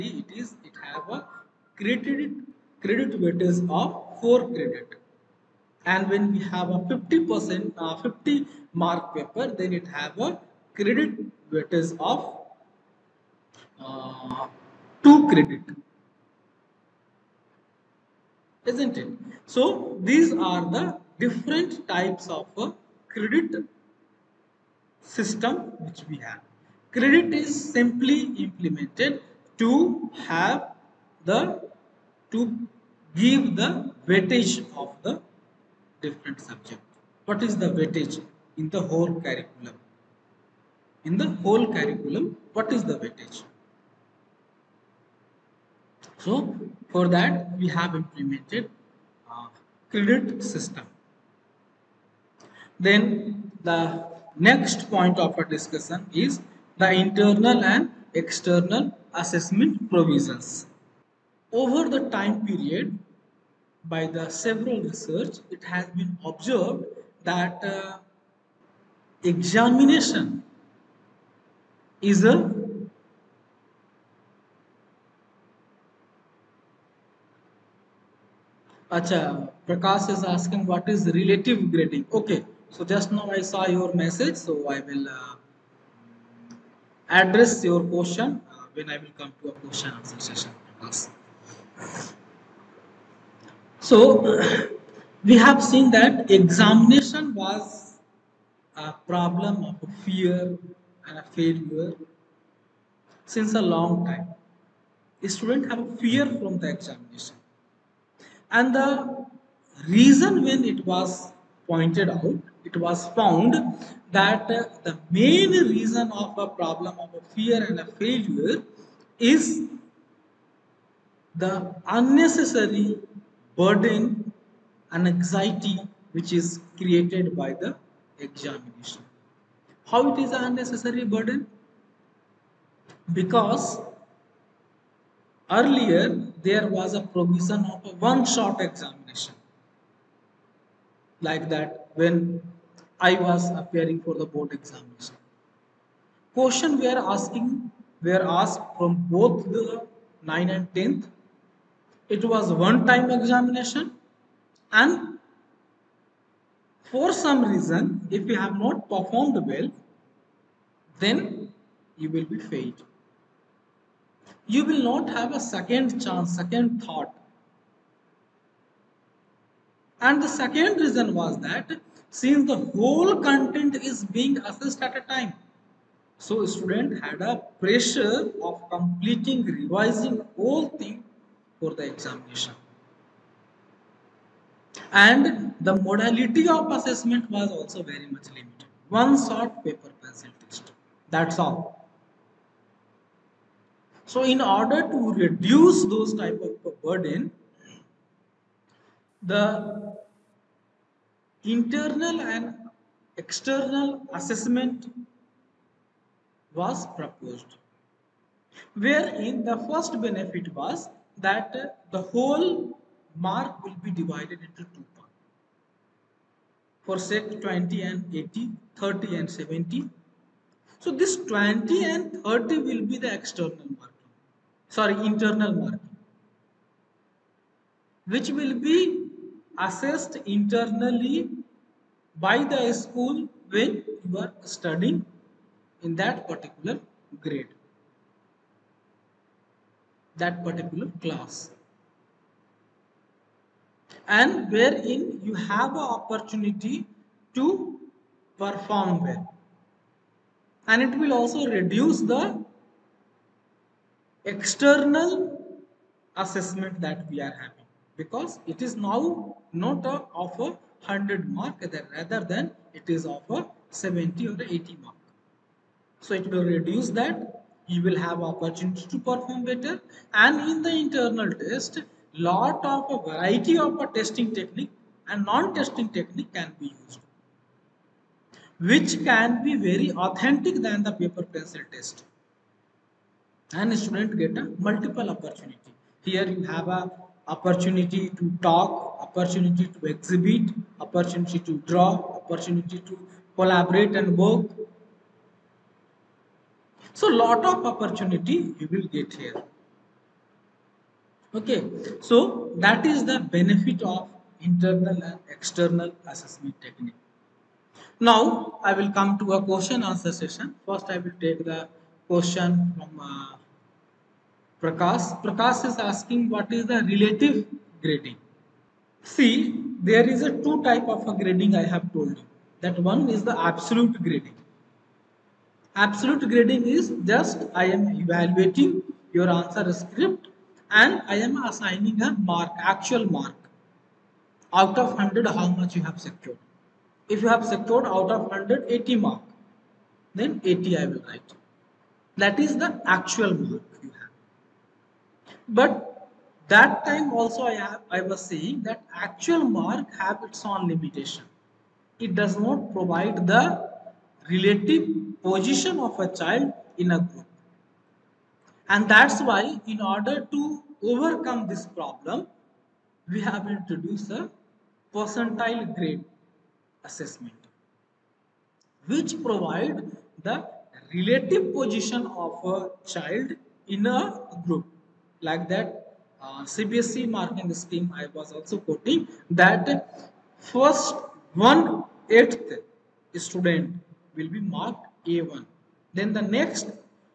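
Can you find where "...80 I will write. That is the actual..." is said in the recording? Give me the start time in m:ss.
5:40.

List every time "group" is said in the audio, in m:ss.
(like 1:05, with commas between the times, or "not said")
5:57, 6:14.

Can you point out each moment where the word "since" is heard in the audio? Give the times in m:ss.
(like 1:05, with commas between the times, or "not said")
1:43, 2:52.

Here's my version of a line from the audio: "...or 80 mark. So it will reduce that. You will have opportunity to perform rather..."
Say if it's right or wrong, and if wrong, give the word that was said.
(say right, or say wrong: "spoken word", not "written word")
wrong: "better", not "rather".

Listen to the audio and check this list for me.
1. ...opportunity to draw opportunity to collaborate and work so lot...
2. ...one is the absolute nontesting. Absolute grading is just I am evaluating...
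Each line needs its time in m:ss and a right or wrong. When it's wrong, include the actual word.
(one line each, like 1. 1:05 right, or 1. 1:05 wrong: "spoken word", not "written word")
1. 4:50 right
2. 5:22 wrong: "grading", not "nontesting".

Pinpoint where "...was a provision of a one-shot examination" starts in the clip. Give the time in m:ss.
2:16.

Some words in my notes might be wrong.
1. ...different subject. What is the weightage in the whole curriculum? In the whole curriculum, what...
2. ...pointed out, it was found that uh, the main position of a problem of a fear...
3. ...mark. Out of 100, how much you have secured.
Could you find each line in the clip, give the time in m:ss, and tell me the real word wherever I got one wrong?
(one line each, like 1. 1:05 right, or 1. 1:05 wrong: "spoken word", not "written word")
1. 0:36 right
2. 1:51 wrong: "reason", not "position"
3. 5:33 right.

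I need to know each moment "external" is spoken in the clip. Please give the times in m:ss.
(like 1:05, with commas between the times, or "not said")
0:58, 3:23, 3:43, 4:14, 5:05.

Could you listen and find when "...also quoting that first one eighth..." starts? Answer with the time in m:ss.
6:18.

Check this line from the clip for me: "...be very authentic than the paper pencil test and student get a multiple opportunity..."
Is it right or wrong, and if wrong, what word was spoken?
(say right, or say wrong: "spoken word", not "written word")
right.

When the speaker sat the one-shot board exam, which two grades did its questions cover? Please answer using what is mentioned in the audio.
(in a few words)
9 and 10th.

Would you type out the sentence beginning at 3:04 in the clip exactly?
And the modality of assessment was also very much limited.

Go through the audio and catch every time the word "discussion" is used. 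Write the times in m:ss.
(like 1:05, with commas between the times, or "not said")
0:55.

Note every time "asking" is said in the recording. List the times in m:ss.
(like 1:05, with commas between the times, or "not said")
1:20, 2:27, 5:15.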